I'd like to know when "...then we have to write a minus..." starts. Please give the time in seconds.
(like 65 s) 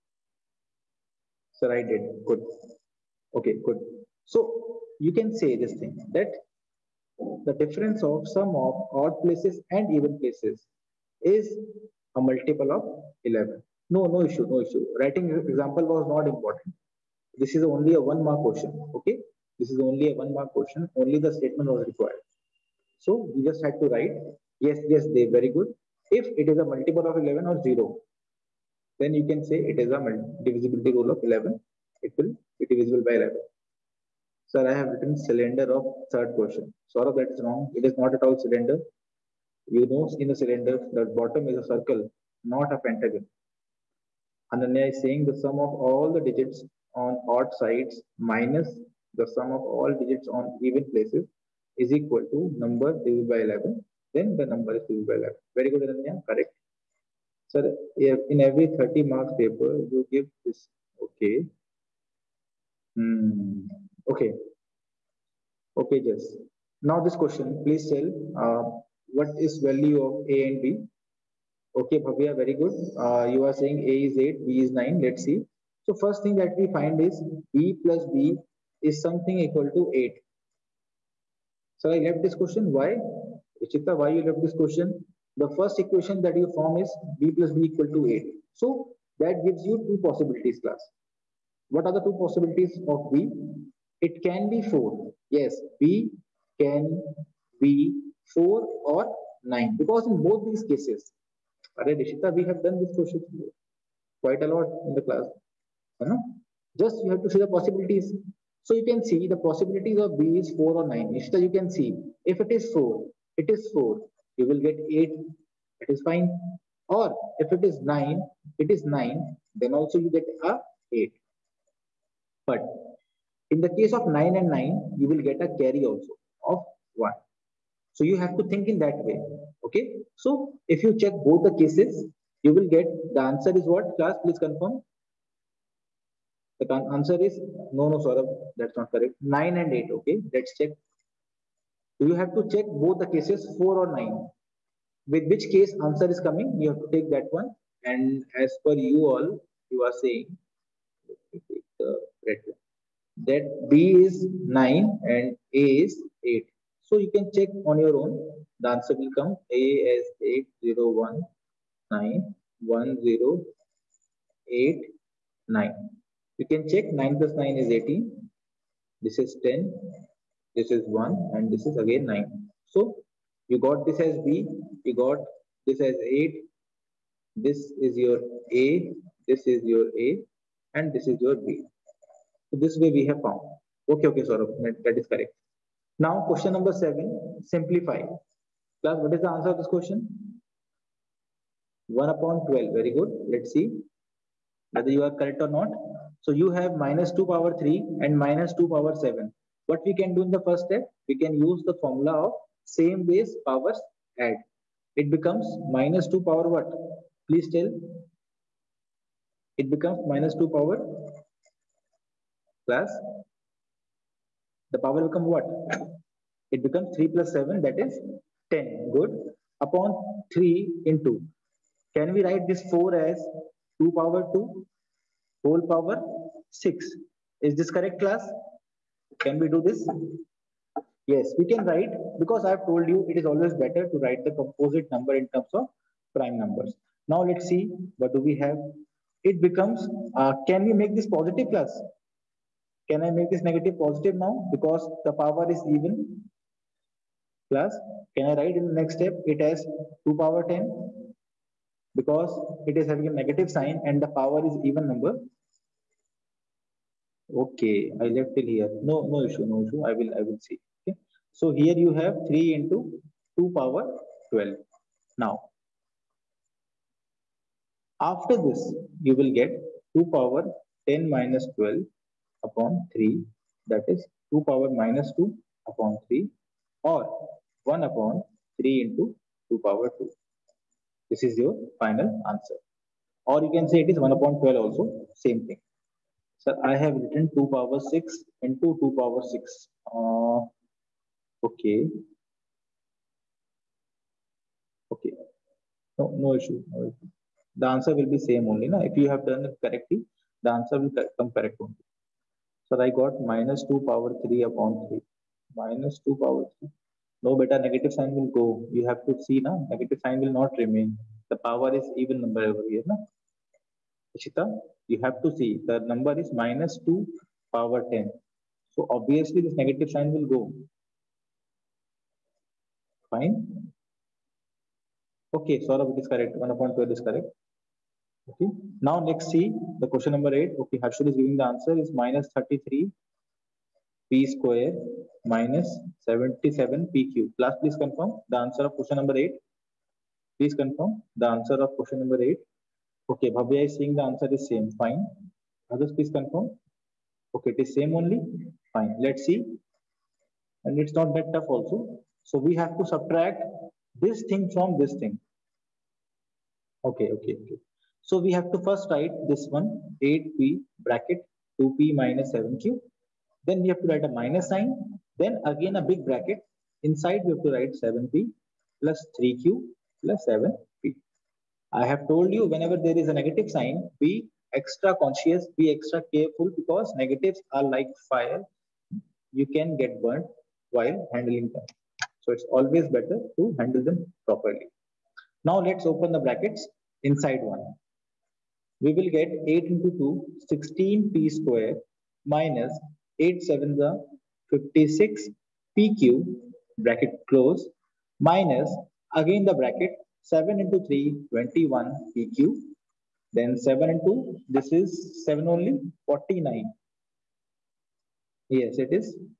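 363 s.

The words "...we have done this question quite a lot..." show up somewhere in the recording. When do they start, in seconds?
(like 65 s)
101 s.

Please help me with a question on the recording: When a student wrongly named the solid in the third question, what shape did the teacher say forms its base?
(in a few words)
circle.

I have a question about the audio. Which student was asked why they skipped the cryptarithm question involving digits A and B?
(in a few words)
Chitta.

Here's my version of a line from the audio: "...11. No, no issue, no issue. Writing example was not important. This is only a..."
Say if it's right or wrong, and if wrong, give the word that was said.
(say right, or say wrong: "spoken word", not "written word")
right.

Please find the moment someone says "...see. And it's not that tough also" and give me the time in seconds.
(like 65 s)
349 s.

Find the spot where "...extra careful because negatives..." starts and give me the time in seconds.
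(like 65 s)
375 s.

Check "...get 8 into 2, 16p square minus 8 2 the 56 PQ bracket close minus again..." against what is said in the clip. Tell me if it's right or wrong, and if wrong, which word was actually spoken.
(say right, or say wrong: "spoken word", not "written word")
wrong: "7", not "2".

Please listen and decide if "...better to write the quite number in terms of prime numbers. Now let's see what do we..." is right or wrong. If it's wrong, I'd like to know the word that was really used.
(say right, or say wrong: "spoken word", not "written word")
wrong: "composite", not "quite".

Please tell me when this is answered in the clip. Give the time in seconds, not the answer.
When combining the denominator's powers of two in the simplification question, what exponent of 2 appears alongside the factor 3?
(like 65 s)
262 s.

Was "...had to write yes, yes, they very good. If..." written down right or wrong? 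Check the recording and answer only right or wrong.
right.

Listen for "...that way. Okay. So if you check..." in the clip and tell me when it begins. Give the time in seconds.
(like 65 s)
128 s.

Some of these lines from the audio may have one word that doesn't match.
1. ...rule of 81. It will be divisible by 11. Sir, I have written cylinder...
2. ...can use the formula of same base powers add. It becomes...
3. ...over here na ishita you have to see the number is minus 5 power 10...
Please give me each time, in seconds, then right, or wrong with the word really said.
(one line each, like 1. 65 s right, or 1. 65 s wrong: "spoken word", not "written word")
1. 30 s wrong: "11", not "81"
2. 201 s right
3. 312 s wrong: "2", not "5".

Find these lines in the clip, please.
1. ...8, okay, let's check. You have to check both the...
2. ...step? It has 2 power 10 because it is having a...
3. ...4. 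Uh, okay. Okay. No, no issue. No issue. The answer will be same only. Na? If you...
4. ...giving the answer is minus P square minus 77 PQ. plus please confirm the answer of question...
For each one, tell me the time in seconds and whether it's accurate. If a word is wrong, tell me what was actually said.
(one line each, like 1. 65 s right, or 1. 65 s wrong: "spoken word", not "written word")
1. 139 s right
2. 248 s right
3. 289 s wrong: "6", not "4"
4. 331 s right.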